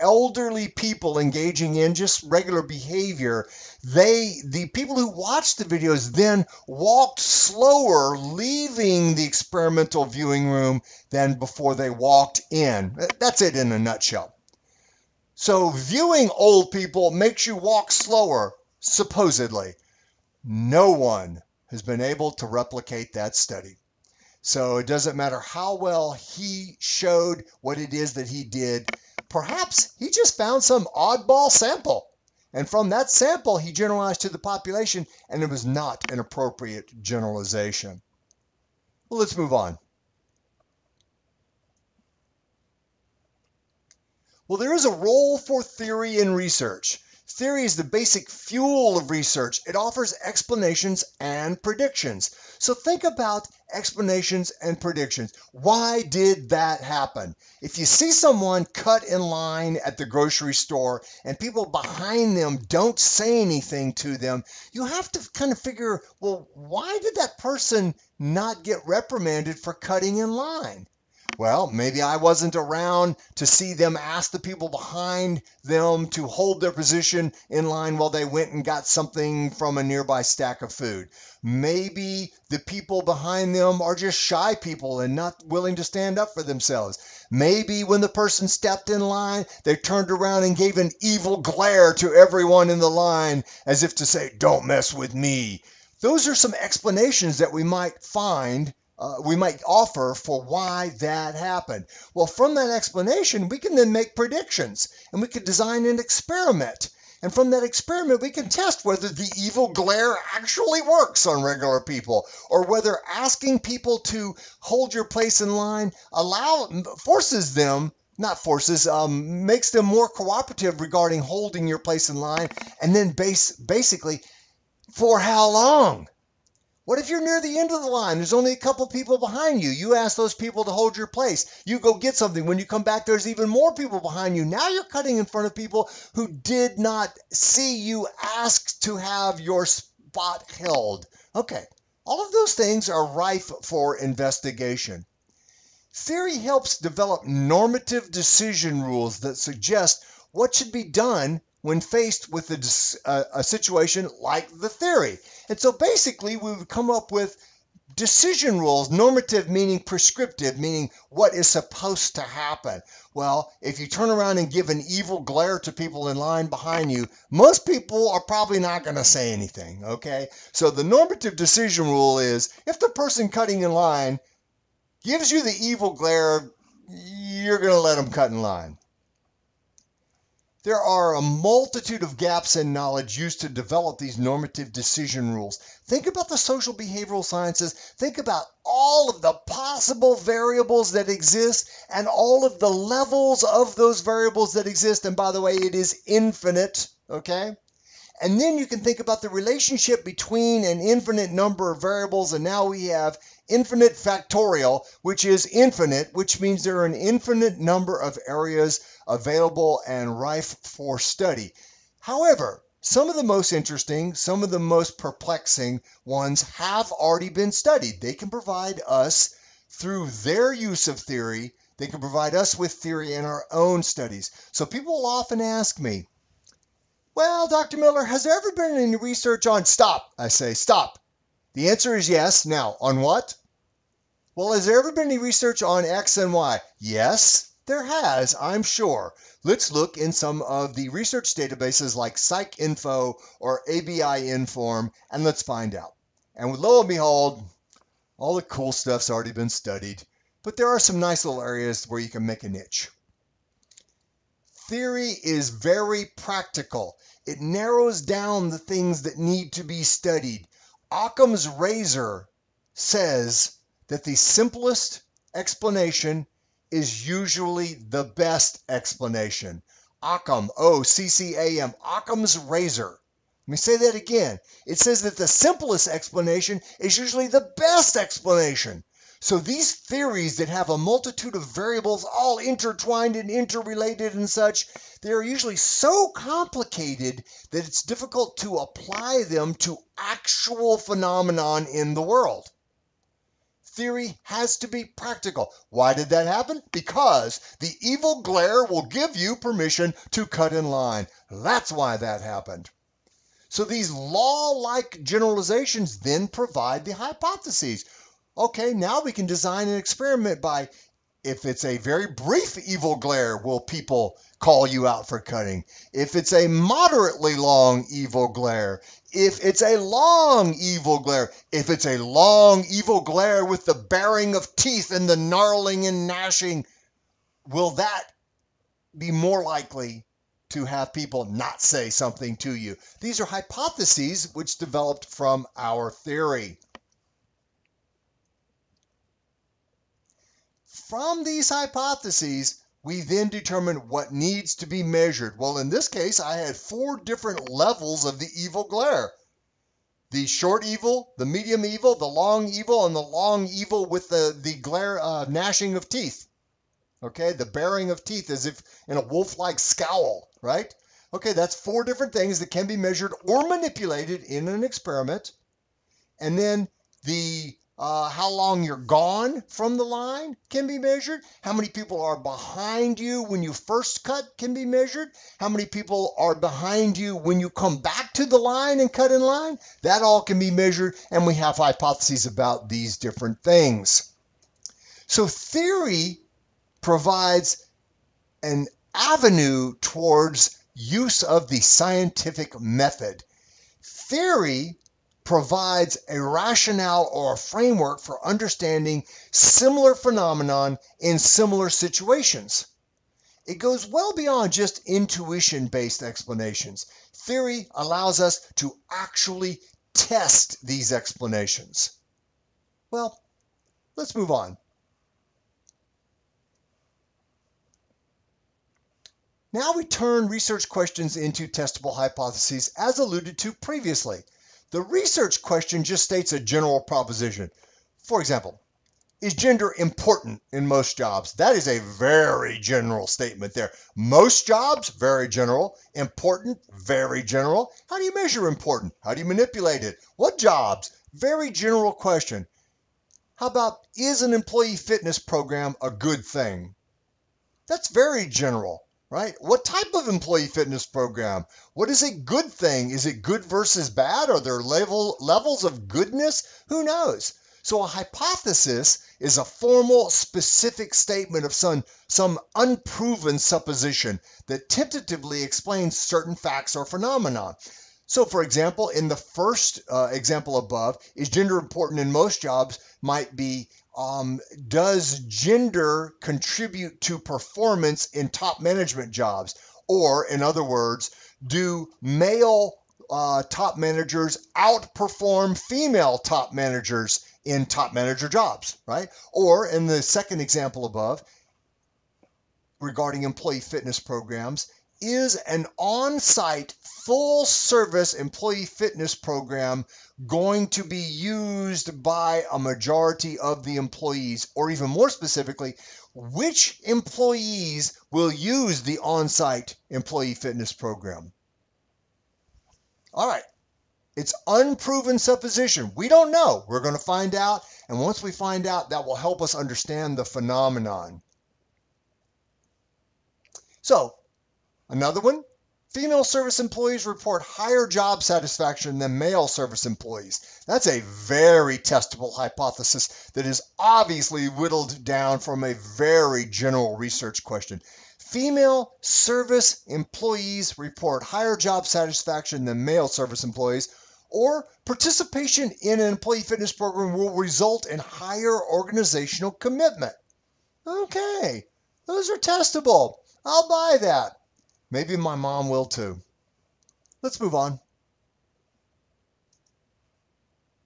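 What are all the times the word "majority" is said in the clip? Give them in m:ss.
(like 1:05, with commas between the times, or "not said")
8:22.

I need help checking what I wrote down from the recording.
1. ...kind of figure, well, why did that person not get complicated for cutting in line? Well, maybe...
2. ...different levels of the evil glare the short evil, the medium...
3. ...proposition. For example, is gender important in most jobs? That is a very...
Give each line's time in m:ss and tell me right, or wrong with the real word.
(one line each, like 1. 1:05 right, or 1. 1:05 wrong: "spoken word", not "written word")
1. 1:05 wrong: "reprimanded", not "complicated"
2. 5:46 right
3. 7:06 right.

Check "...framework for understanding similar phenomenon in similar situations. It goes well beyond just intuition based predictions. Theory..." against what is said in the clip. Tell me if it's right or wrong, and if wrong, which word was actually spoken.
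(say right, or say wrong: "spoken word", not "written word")
wrong: "explanations", not "predictions".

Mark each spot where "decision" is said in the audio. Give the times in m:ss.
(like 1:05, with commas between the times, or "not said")
2:28, 2:37, 2:51, 3:04.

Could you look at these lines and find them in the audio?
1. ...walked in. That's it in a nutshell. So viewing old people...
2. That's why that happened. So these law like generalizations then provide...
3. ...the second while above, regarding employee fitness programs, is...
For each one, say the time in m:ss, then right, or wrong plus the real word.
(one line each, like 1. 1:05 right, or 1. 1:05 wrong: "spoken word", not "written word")
1. 0:11 right
2. 5:01 right
3. 8:09 wrong: "example", not "while".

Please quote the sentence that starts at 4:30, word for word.
Occam, O C C A M, Occam's razor.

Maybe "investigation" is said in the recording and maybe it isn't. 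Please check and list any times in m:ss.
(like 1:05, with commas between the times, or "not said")
2:23.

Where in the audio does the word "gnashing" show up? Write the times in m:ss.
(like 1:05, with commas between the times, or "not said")
5:26, 5:55.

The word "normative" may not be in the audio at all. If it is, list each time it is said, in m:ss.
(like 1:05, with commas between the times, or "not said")
2:27, 2:38, 2:50, 3:04.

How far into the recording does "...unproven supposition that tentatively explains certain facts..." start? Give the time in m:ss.
7:42.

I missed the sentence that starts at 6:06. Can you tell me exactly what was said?
And then the uh, how long you're gone from the line can be measured.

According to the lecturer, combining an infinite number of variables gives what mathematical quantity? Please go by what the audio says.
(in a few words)
infinite factorial.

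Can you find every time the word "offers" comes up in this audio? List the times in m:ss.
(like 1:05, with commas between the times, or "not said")
0:49, 1:39.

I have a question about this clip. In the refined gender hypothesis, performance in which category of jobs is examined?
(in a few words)
top management jobs.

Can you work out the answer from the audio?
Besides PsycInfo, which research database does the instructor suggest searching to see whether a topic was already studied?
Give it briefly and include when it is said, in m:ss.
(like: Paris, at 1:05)
ABI Inform, at 4:03.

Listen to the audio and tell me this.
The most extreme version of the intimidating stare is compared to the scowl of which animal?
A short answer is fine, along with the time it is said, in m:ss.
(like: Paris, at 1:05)
wolf, at 5:59.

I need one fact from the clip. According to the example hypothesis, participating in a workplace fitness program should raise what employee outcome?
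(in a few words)
organizational commitment.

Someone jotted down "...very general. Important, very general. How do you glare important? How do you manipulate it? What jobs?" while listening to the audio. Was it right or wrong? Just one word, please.
wrong.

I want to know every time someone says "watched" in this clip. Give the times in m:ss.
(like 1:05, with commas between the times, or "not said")
0:05.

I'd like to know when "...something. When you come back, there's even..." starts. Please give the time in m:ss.
2:12.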